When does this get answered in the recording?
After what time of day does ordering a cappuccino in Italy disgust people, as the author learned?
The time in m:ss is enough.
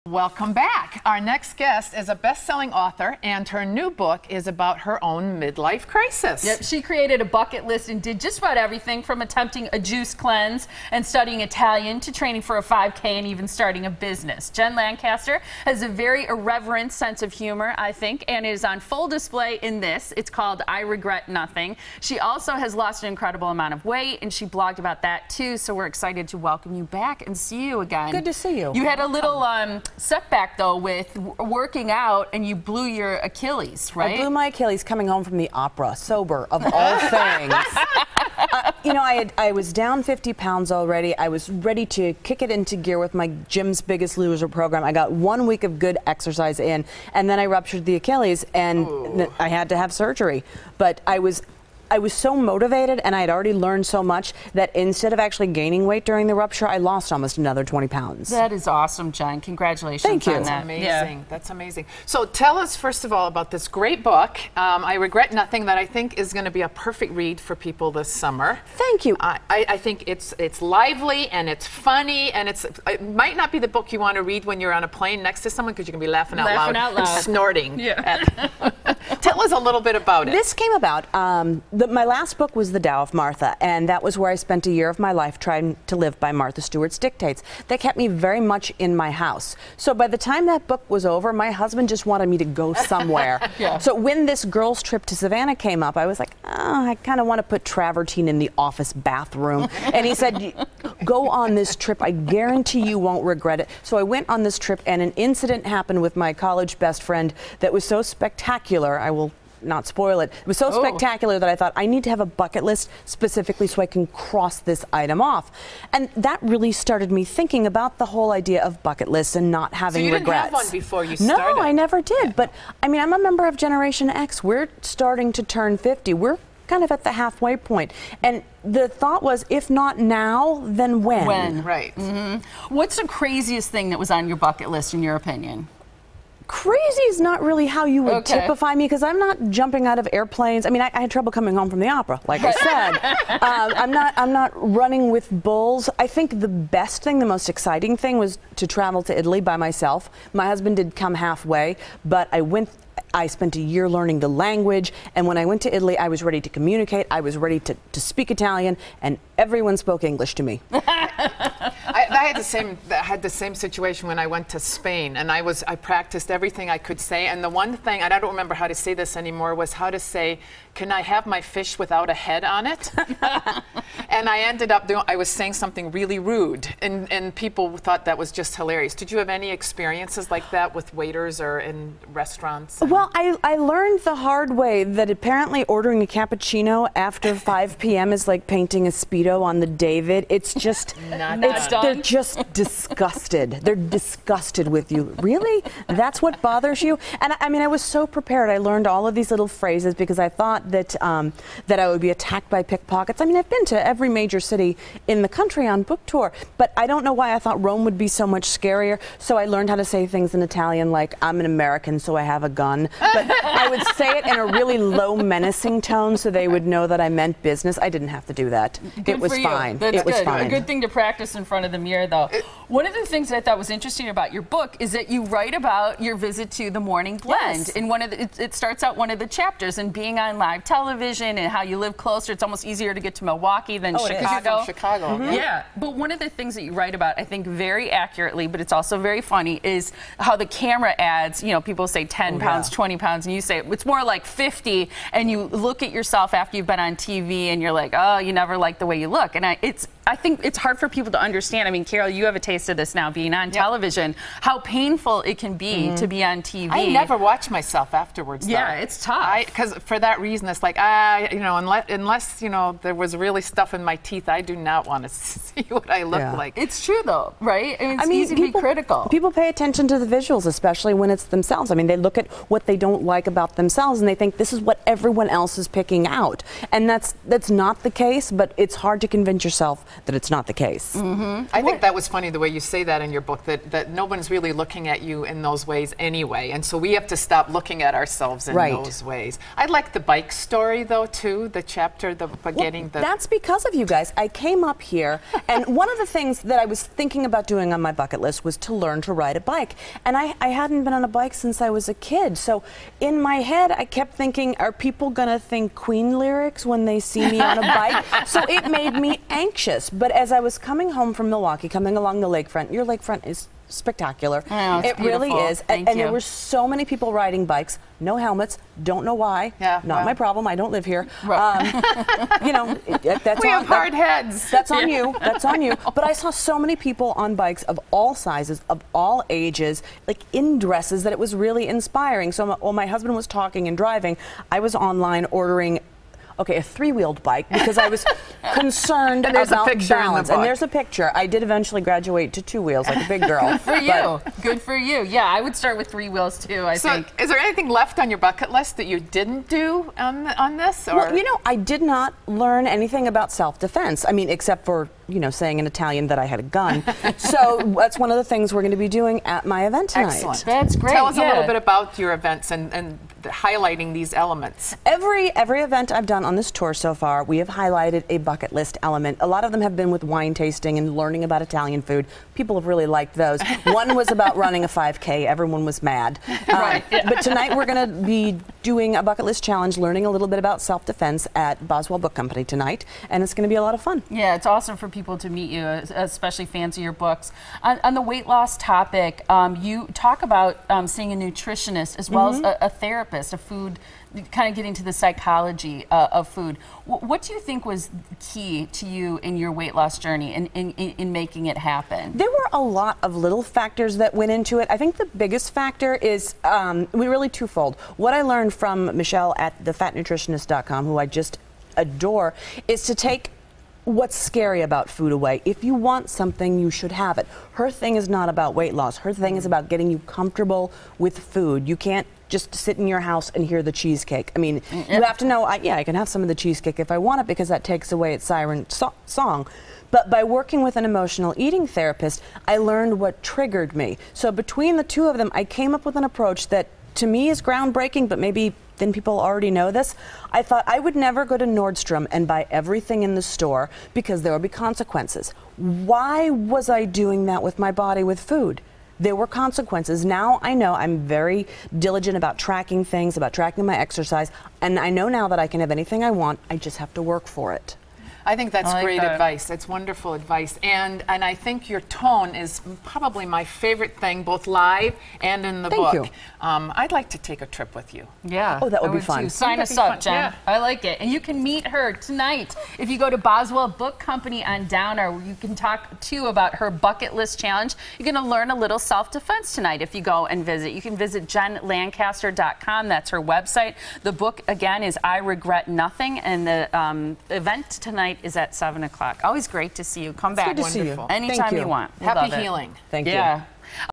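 3:07.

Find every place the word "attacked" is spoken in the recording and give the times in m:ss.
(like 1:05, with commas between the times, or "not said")
3:22.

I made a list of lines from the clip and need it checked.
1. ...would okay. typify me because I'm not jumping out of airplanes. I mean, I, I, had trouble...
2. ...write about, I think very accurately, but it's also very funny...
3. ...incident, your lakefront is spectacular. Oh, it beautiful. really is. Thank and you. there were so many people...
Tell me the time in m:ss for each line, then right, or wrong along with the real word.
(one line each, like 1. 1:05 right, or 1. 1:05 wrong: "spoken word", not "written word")
1. 2:18 right
2. 3:56 right
3. 5:12 wrong: "lakefront", not "incident".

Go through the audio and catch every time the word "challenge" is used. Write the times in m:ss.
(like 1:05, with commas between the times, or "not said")
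6:19, 7:57.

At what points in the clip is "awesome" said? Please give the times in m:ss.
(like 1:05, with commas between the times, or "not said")
0:58, 6:24.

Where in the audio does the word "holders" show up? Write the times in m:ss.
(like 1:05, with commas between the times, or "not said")
not said.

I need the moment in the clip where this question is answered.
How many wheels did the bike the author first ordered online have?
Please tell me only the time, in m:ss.
5:36.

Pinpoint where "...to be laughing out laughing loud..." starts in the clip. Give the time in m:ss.
1:15.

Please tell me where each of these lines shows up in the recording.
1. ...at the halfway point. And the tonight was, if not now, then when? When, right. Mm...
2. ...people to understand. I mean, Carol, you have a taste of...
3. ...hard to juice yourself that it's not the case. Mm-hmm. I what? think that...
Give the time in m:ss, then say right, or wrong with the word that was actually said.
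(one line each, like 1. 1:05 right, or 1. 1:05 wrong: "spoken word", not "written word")
1. 2:06 wrong: "thought", not "tonight"
2. 4:10 right
3. 4:38 wrong: "convince", not "juice".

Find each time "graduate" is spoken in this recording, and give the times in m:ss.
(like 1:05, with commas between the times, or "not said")
5:41.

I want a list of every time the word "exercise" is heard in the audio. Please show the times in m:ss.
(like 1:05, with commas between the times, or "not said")
0:46, 7:33.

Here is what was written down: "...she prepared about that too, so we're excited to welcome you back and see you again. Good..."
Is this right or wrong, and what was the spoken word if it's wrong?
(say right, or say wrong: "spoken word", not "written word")
wrong: "blogged", not "prepared".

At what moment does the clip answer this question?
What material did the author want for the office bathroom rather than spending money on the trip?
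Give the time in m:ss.
1:37.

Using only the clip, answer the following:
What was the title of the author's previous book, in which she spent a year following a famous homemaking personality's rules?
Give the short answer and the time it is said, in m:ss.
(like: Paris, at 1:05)
The Tao of Martha, at 1:22.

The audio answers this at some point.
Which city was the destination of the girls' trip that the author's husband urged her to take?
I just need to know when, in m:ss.
1:35.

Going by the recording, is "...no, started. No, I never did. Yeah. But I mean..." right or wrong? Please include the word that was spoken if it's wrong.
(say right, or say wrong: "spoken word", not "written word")
right.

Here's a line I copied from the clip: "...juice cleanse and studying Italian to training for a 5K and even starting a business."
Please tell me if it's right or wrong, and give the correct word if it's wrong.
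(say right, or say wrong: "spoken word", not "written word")
right.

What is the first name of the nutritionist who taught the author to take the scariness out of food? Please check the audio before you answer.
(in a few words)
Michelle.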